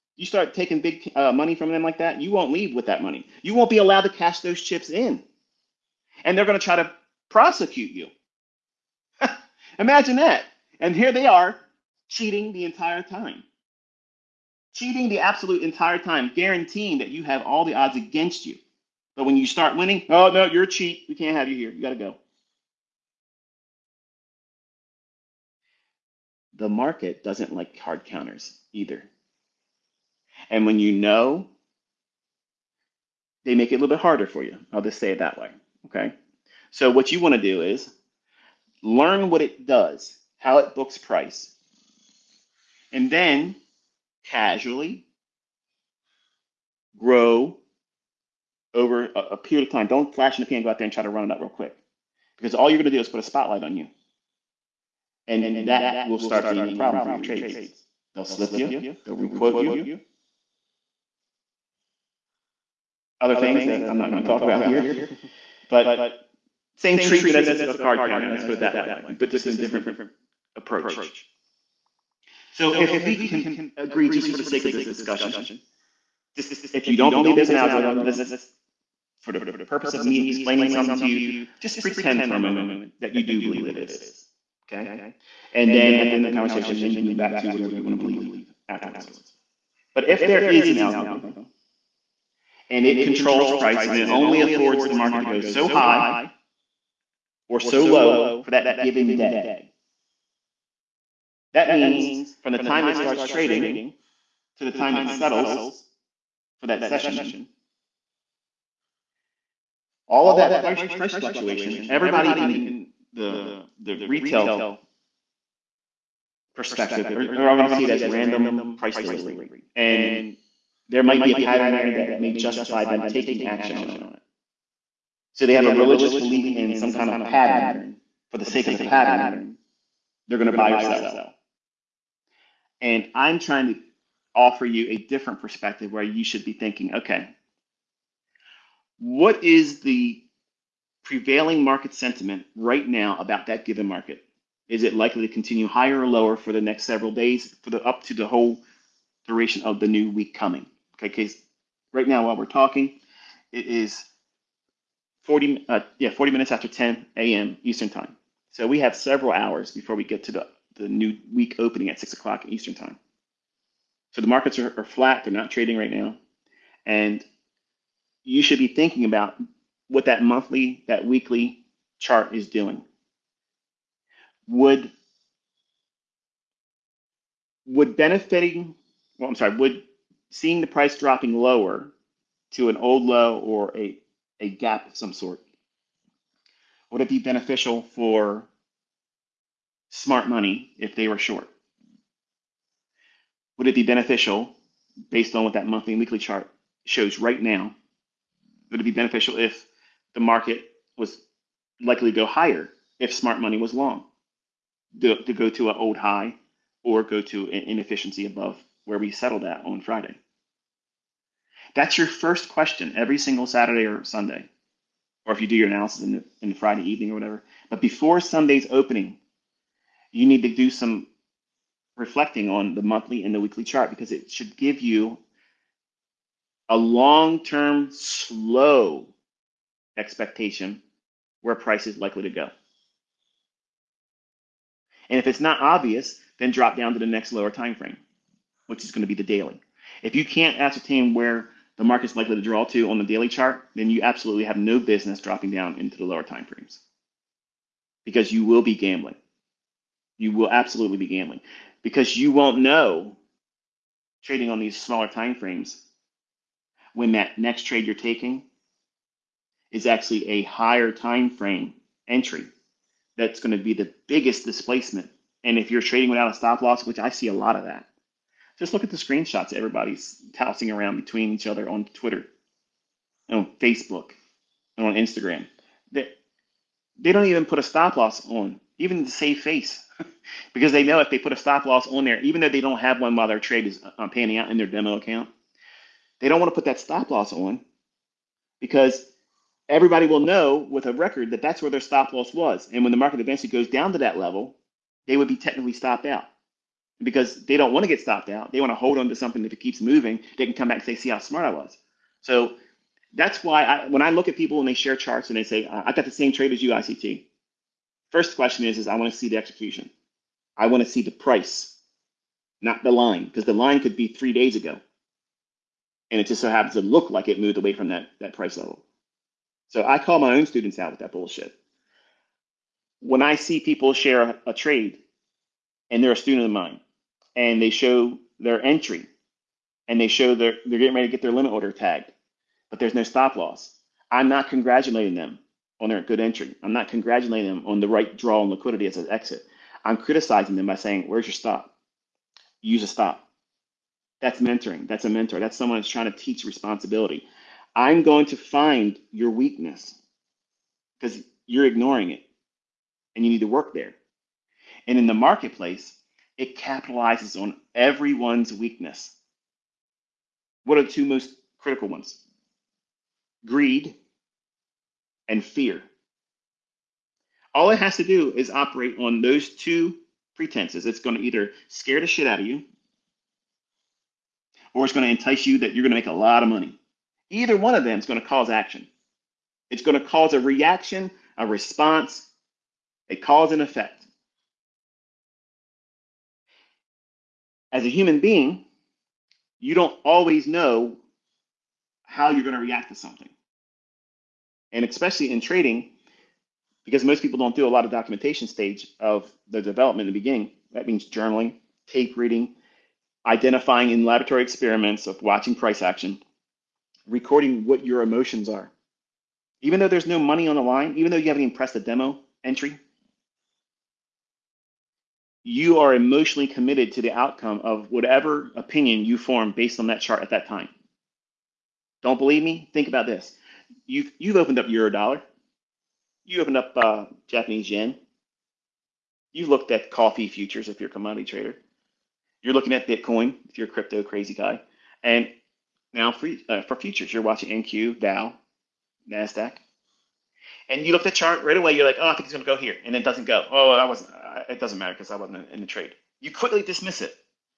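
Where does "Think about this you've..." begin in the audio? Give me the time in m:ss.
7:02.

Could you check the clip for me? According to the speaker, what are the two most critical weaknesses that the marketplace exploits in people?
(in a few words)
Greed and fear.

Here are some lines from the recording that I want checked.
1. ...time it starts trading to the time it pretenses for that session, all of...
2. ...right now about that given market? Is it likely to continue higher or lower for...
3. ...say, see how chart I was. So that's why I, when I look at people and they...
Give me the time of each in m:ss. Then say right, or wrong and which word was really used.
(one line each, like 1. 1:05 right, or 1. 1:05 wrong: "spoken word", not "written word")
1. 1:42 wrong: "settles", not "pretenses"
2. 2:22 right
3. 5:00 wrong: "smart", not "chart".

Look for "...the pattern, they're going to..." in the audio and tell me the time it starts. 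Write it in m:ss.
2:08.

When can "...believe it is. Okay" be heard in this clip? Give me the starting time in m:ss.
1:23.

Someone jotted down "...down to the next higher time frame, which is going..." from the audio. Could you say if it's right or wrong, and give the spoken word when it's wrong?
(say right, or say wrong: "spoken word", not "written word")
wrong: "lower", not "higher".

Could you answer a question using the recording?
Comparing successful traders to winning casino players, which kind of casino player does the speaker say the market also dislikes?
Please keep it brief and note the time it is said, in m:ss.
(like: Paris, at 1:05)
hard counters, at 0:27.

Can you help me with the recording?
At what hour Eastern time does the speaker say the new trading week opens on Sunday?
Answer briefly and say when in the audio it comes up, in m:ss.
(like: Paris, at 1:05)
6:00, at 2:41.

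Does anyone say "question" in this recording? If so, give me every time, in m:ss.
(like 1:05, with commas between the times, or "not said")
3:32, 5:08.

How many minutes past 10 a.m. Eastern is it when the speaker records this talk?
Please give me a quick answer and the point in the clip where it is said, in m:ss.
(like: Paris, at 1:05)
40, at 2:36.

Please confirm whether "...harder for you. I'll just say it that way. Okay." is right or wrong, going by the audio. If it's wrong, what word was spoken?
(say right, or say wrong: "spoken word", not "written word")
right.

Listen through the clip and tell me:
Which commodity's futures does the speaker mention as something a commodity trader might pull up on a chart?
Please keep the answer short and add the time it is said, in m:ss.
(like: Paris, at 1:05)
coffee, at 7:09.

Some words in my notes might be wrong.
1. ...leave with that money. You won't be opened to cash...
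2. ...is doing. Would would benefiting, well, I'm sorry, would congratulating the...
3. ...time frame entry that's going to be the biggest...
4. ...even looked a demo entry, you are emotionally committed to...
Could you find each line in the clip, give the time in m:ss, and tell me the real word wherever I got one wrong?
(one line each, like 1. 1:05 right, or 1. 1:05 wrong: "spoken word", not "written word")
1. 0:02 wrong: "allowed", not "opened"
2. 2:52 wrong: "seeing", not "congratulating"
3. 4:20 right
4. 6:51 wrong: "pressed", not "looked".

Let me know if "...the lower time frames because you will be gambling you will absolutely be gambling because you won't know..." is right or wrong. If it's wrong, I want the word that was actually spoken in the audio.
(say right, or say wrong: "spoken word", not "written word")
right.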